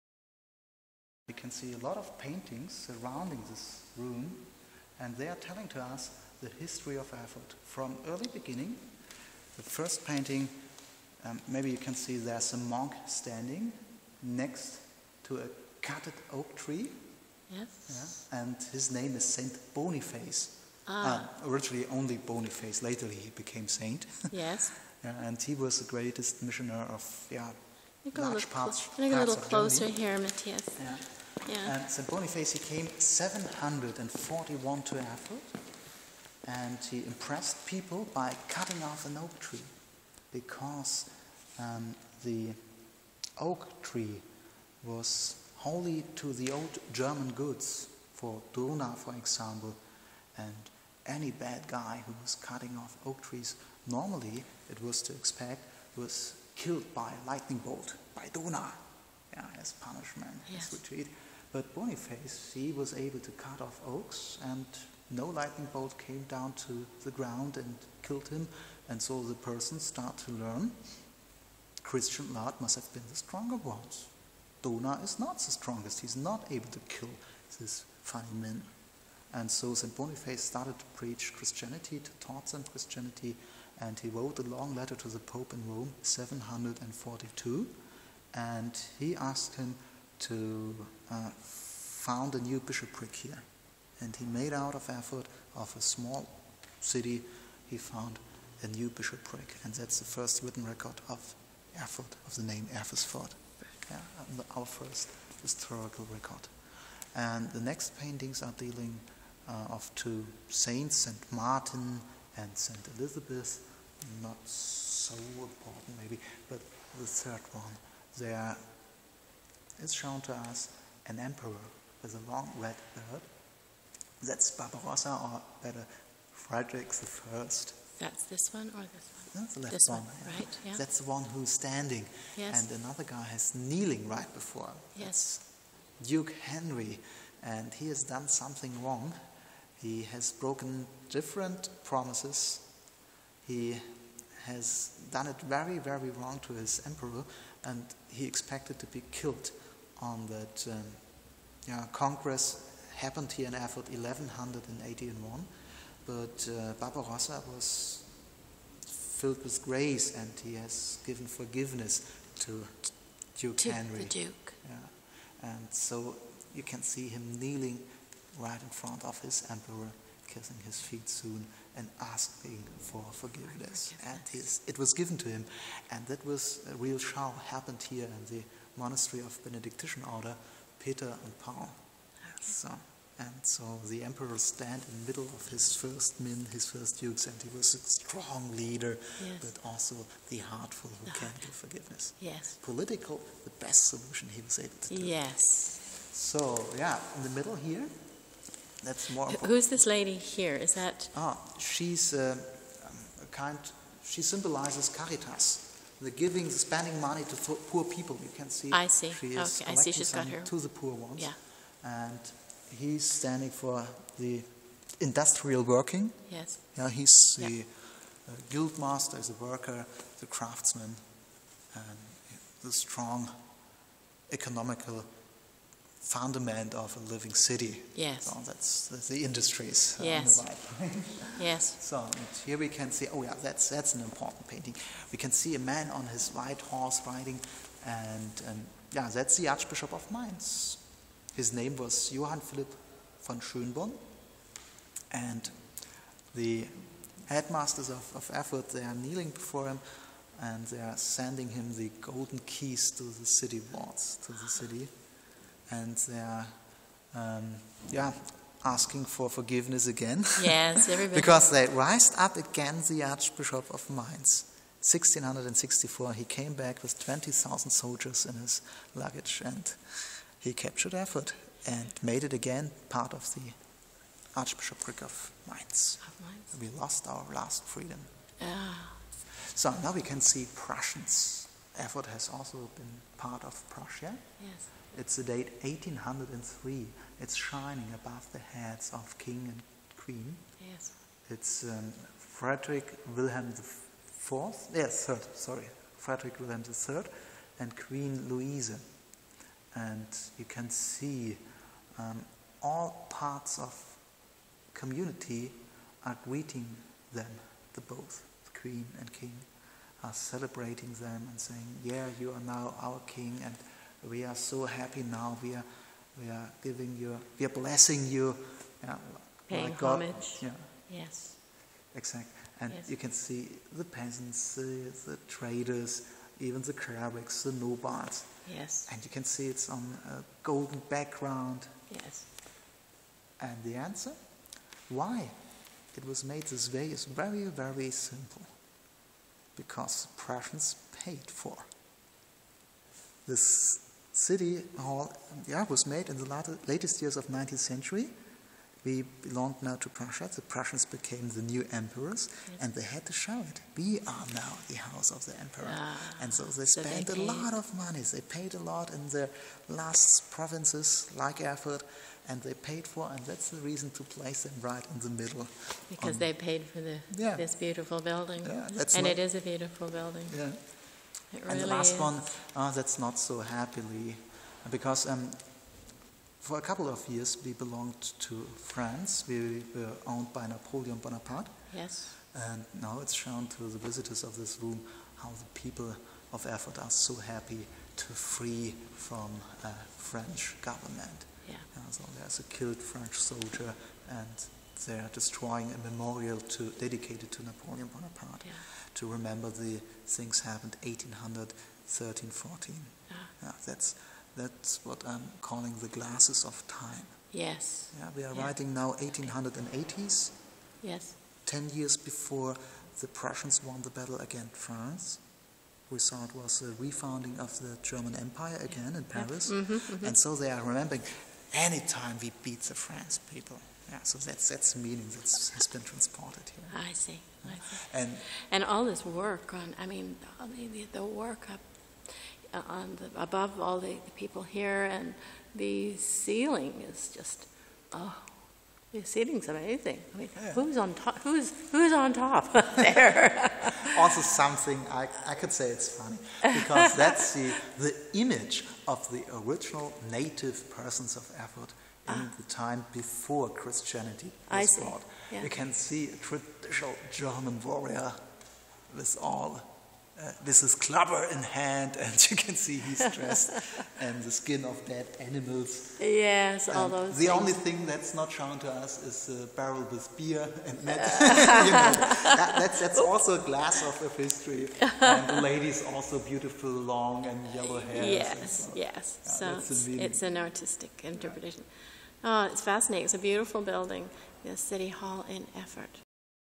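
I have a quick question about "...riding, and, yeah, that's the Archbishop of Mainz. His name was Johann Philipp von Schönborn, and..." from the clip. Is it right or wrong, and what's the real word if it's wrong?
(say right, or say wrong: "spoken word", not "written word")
right.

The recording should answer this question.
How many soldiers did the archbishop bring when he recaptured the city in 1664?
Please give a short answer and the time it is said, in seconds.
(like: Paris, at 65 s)
20,000, at 267 s.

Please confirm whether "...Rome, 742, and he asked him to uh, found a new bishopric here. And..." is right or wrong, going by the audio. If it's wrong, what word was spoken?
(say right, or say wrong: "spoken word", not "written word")
right.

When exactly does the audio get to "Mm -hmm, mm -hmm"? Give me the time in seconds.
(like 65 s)
419 s.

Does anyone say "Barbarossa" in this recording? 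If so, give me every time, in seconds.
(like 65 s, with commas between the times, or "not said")
124 s, 156 s.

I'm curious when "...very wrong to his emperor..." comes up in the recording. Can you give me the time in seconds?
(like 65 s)
145 s.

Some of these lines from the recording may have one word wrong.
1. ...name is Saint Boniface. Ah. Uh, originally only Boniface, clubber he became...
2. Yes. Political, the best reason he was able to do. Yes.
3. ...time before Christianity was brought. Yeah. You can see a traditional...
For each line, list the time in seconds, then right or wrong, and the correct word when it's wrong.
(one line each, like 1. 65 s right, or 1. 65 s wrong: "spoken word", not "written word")
1. 18 s wrong: "later", not "clubber"
2. 192 s wrong: "solution", not "reason"
3. 452 s right.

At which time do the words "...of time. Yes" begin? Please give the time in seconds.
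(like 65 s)
406 s.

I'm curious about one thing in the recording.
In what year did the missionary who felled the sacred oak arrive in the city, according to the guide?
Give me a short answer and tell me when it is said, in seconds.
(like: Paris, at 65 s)
741, at 32 s.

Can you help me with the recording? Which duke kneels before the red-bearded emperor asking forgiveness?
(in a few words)
Duke Henry.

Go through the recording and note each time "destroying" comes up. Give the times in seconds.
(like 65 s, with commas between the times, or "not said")
395 s.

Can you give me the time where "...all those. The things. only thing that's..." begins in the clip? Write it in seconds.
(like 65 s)
466 s.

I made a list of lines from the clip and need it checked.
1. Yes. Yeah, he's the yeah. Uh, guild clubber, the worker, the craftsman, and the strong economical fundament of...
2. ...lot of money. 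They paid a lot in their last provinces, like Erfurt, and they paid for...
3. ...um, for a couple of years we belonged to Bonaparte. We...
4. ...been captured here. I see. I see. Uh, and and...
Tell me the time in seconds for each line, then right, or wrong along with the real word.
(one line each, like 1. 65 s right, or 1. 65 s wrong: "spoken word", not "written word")
1. 216 s wrong: "master", not "clubber"
2. 357 s right
3. 375 s wrong: "France", not "Bonaparte"
4. 425 s wrong: "transported", not "captured".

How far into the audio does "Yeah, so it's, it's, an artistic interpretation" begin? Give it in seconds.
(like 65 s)
479 s.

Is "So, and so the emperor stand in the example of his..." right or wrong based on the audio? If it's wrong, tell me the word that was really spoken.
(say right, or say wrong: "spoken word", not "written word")
wrong: "middle", not "example".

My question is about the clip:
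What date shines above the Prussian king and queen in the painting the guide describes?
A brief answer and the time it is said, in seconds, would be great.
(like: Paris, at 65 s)
1803, at 285 s.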